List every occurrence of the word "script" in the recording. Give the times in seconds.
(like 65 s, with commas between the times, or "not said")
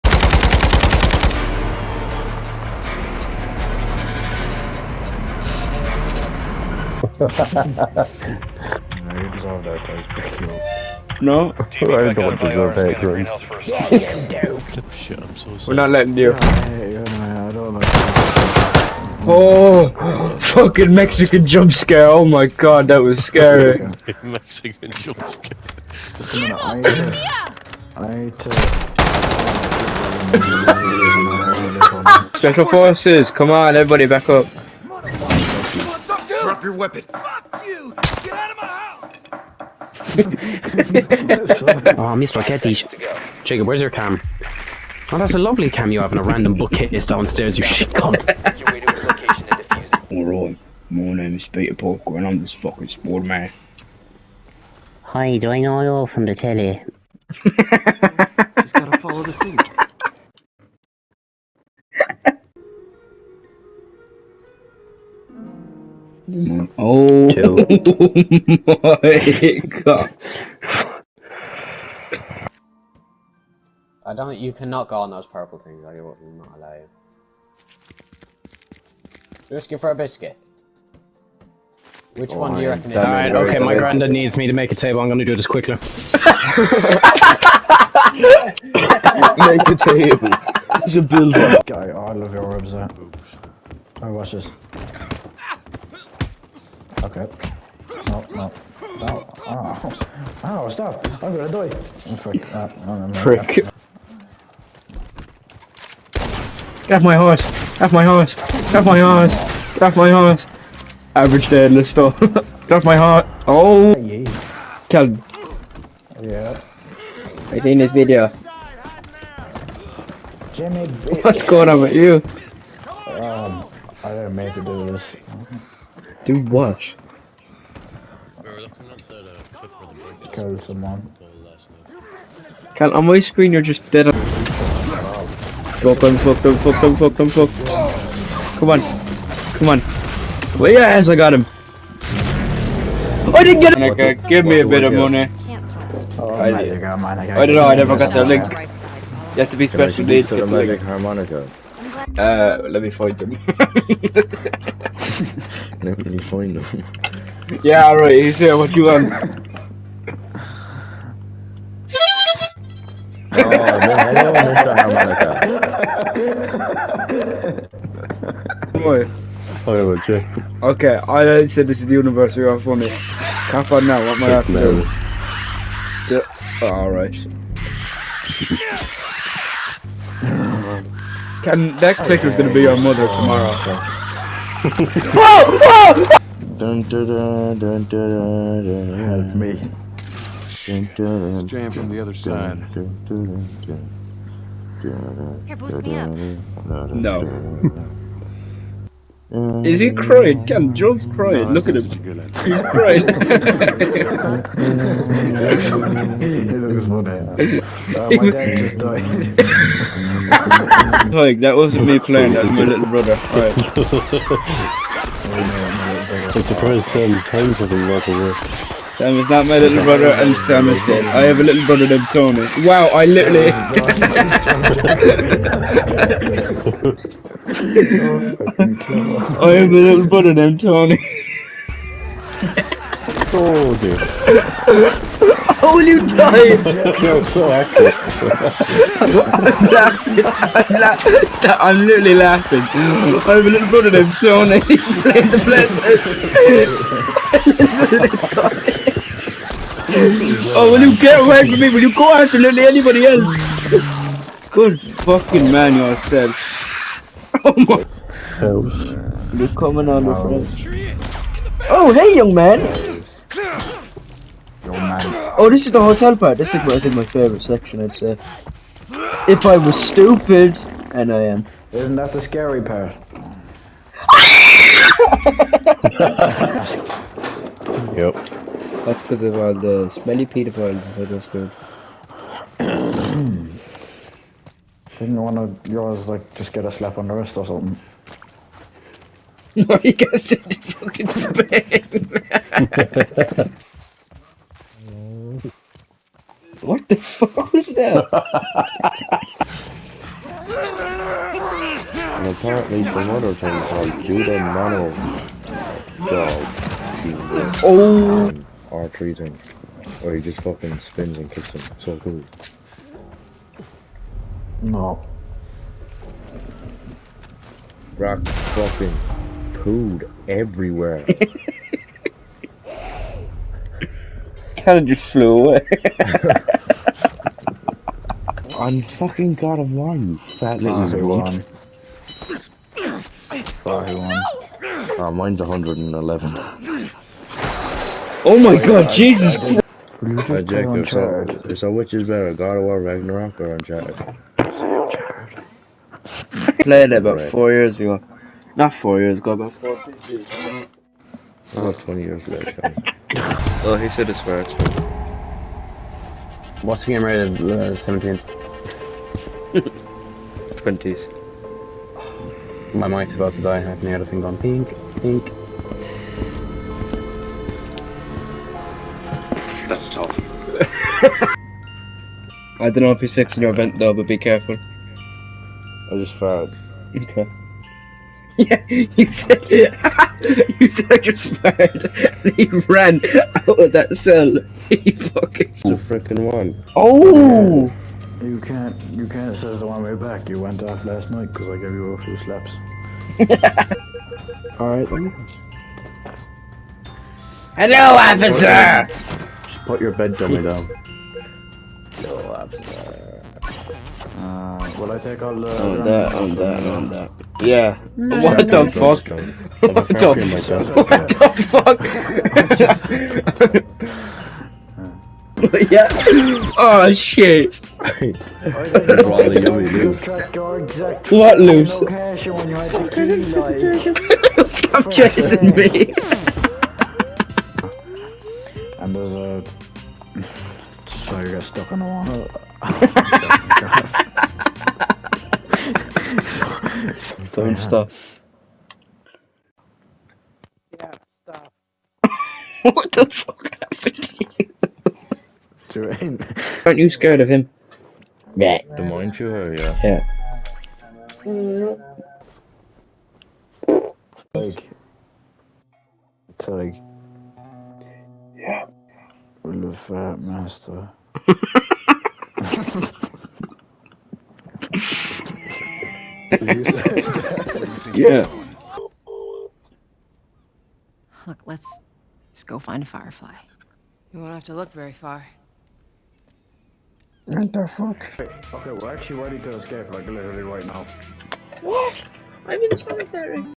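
not said.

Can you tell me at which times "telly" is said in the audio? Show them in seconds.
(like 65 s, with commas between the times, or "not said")
56 s.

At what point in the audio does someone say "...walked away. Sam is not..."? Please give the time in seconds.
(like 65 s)
217 s.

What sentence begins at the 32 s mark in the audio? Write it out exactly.
Special forces, come on, everybody, back up your weapon.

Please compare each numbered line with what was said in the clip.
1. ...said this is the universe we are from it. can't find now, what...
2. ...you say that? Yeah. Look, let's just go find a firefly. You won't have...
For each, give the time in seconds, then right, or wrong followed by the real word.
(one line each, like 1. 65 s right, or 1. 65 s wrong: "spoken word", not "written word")
1. 171 s right
2. 466 s right.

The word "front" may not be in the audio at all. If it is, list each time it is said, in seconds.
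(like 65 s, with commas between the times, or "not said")
243 s, 260 s.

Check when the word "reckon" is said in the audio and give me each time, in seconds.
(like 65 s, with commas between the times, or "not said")
82 s.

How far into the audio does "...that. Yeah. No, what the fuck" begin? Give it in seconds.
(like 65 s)
406 s.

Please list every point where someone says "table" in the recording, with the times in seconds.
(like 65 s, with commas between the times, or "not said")
84 s, 89 s.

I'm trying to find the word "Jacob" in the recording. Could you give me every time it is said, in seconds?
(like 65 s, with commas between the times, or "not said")
43 s, 340 s.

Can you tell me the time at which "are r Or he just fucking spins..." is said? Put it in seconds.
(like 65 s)
308 s.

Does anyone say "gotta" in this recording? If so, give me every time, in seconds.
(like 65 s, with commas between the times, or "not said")
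58 s, 289 s.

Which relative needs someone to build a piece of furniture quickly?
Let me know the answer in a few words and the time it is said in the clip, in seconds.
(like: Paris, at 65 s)
granddad, at 83 s.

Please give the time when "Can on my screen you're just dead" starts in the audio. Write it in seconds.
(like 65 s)
132 s.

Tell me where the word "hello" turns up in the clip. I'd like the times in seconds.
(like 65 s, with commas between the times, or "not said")
164 s, 397 s.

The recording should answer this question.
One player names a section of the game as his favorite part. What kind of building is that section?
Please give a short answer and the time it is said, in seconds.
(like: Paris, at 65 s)
hotel, at 265 s.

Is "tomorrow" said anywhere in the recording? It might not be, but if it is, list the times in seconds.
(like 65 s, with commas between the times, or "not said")
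183 s.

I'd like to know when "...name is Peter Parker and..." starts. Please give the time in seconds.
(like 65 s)
51 s.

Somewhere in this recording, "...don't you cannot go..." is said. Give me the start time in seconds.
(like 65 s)
74 s.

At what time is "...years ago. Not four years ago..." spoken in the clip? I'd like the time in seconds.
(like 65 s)
347 s.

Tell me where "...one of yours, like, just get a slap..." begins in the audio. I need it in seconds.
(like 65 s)
285 s.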